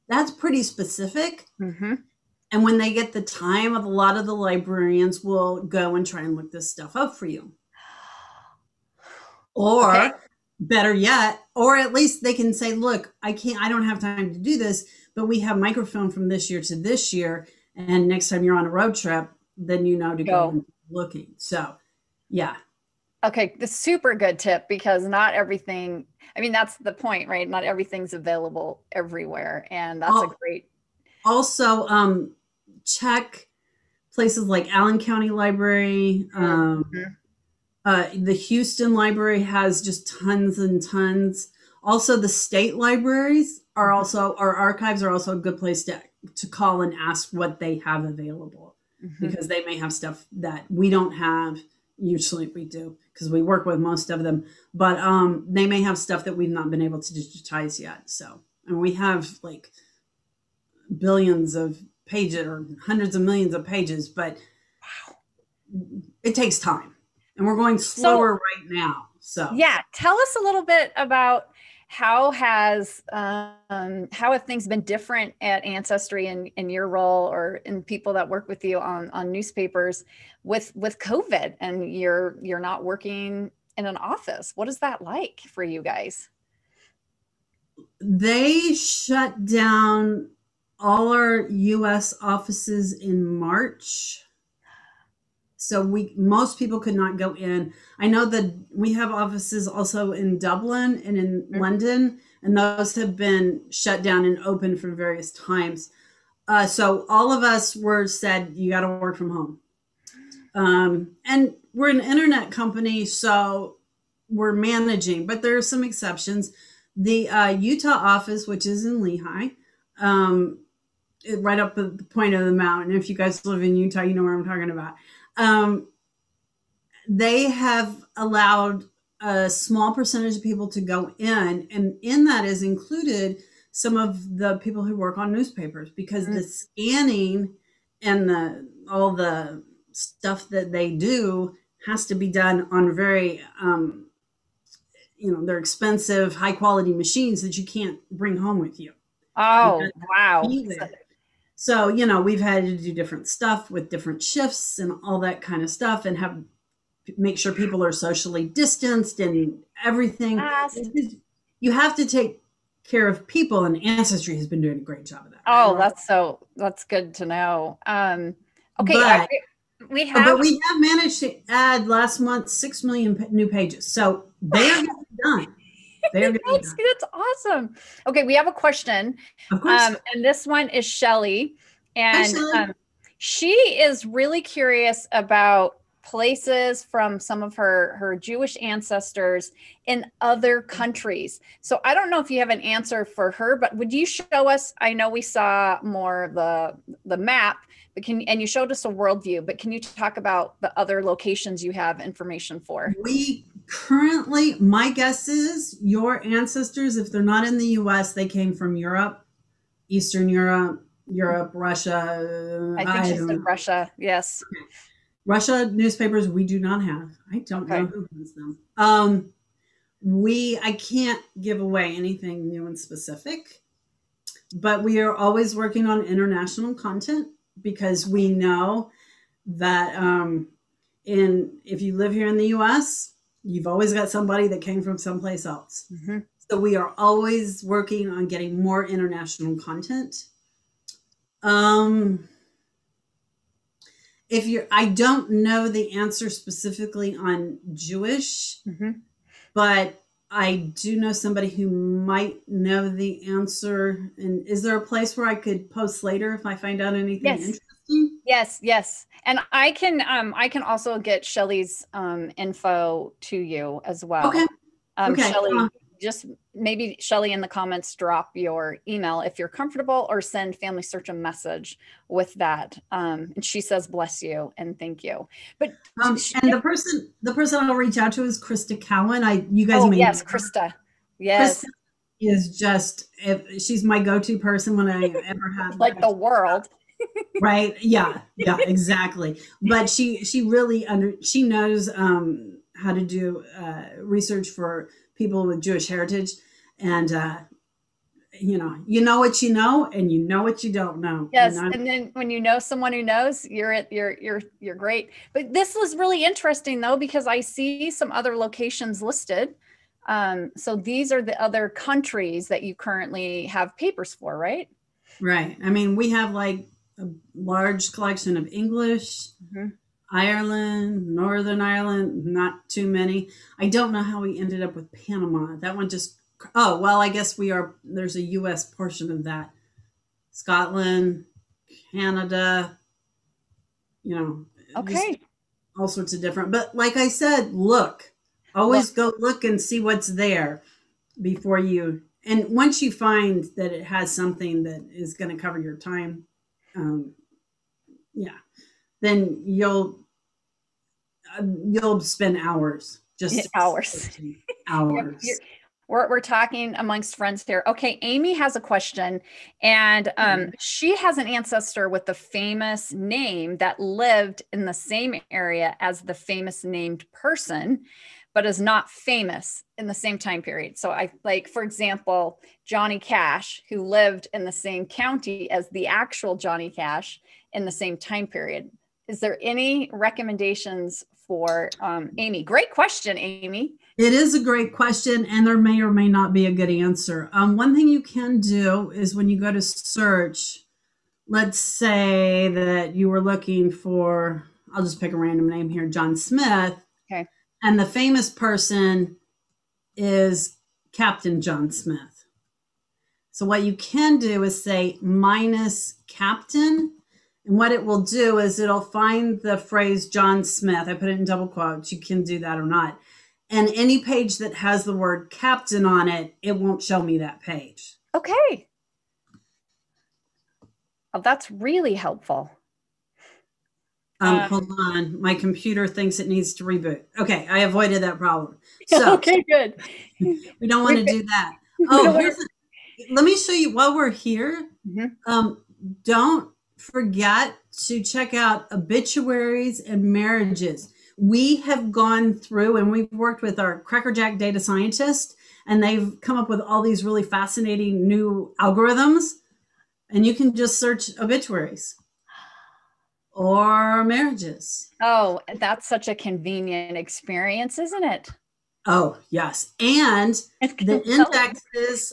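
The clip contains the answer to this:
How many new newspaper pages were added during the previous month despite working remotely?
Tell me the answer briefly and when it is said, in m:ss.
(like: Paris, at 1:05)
6 million, at 2:52.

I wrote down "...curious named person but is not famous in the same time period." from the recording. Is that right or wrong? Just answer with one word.
wrong.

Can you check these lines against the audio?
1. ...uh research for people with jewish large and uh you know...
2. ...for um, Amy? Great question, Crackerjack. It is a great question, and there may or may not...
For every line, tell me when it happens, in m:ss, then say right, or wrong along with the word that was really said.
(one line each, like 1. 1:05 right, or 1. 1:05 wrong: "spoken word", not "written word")
1. 4:53 wrong: "heritage", not "large"
2. 6:21 wrong: "Amy", not "Crackerjack".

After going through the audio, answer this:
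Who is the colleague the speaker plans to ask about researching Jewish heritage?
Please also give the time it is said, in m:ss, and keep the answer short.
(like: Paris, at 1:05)
Crista Cowan, at 4:38.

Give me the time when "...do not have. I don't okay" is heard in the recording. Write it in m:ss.
3:36.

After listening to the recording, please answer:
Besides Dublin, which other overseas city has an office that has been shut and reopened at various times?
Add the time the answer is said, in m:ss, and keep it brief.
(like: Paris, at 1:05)
London, at 1:41.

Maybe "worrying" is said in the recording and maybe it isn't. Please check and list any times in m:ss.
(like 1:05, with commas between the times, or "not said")
not said.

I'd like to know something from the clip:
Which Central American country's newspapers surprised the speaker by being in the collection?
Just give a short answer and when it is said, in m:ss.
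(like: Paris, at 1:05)
Panama, at 5:24.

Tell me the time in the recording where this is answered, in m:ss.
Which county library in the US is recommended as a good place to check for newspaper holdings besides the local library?
0:34.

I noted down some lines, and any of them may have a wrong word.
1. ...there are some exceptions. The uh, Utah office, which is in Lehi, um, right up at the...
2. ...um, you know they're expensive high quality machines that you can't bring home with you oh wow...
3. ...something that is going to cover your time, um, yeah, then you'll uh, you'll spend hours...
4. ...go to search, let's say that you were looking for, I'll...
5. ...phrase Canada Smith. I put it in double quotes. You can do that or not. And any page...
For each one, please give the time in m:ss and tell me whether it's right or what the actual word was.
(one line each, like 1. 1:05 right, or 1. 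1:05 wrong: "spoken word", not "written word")
1. 1:55 right
2. 2:23 right
3. 5:44 right
4. 6:29 right
5. 6:49 wrong: "John", not "Canada".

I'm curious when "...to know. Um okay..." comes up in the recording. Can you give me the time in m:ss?
2:47.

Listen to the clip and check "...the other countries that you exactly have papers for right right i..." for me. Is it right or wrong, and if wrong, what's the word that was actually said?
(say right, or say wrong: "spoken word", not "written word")
wrong: "currently", not "exactly".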